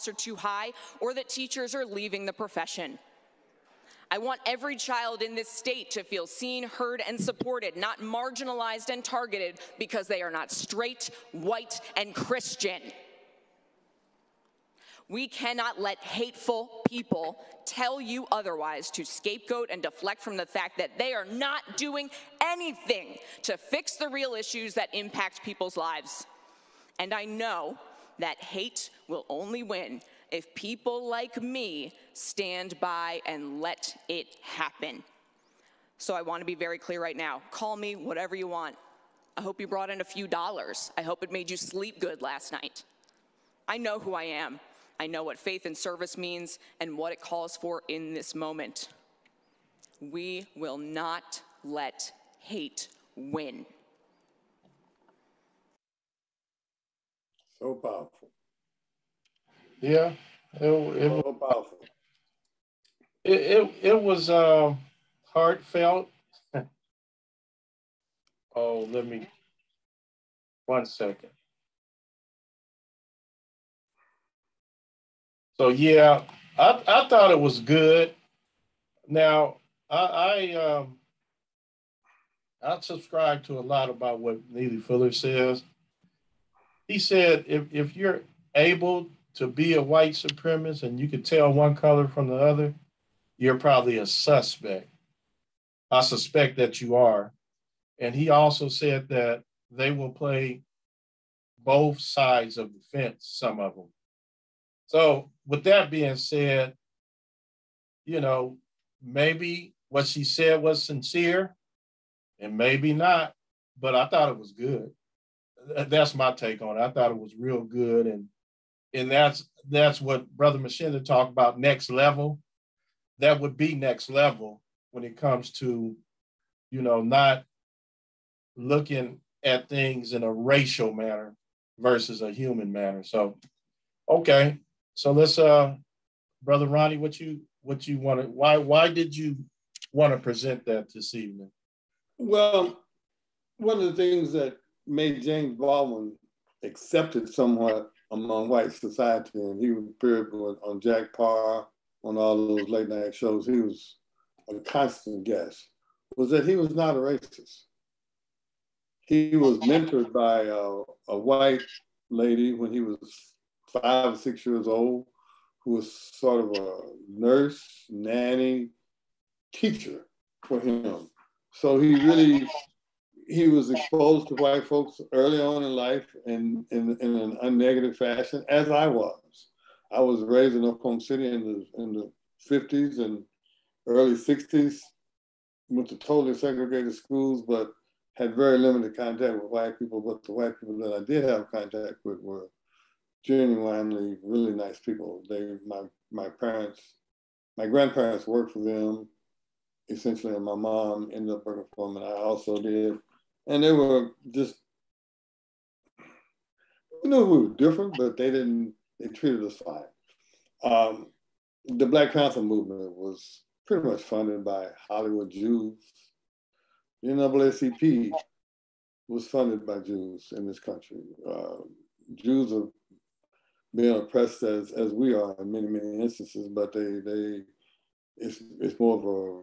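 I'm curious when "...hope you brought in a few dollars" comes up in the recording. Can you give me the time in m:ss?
0:39.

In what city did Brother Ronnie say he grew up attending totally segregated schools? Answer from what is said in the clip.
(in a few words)
Oklahoma City.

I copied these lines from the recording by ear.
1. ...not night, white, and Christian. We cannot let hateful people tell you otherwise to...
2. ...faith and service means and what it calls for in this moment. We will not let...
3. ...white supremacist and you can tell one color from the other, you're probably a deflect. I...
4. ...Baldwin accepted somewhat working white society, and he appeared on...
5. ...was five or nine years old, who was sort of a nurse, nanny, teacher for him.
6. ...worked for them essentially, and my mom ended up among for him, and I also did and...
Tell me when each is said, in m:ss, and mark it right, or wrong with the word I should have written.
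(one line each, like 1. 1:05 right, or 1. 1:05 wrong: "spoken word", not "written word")
1. 0:10 wrong: "straight", not "night"
2. 0:45 right
3. 1:29 wrong: "suspect", not "deflect"
4. 2:25 wrong: "among", not "working"
5. 2:42 wrong: "six", not "nine"
6. 3:18 wrong: "working", not "among".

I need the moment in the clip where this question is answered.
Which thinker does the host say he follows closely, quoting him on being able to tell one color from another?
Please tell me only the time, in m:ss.
1:24.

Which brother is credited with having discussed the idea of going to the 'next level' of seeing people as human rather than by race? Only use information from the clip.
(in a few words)
Brother Machinda.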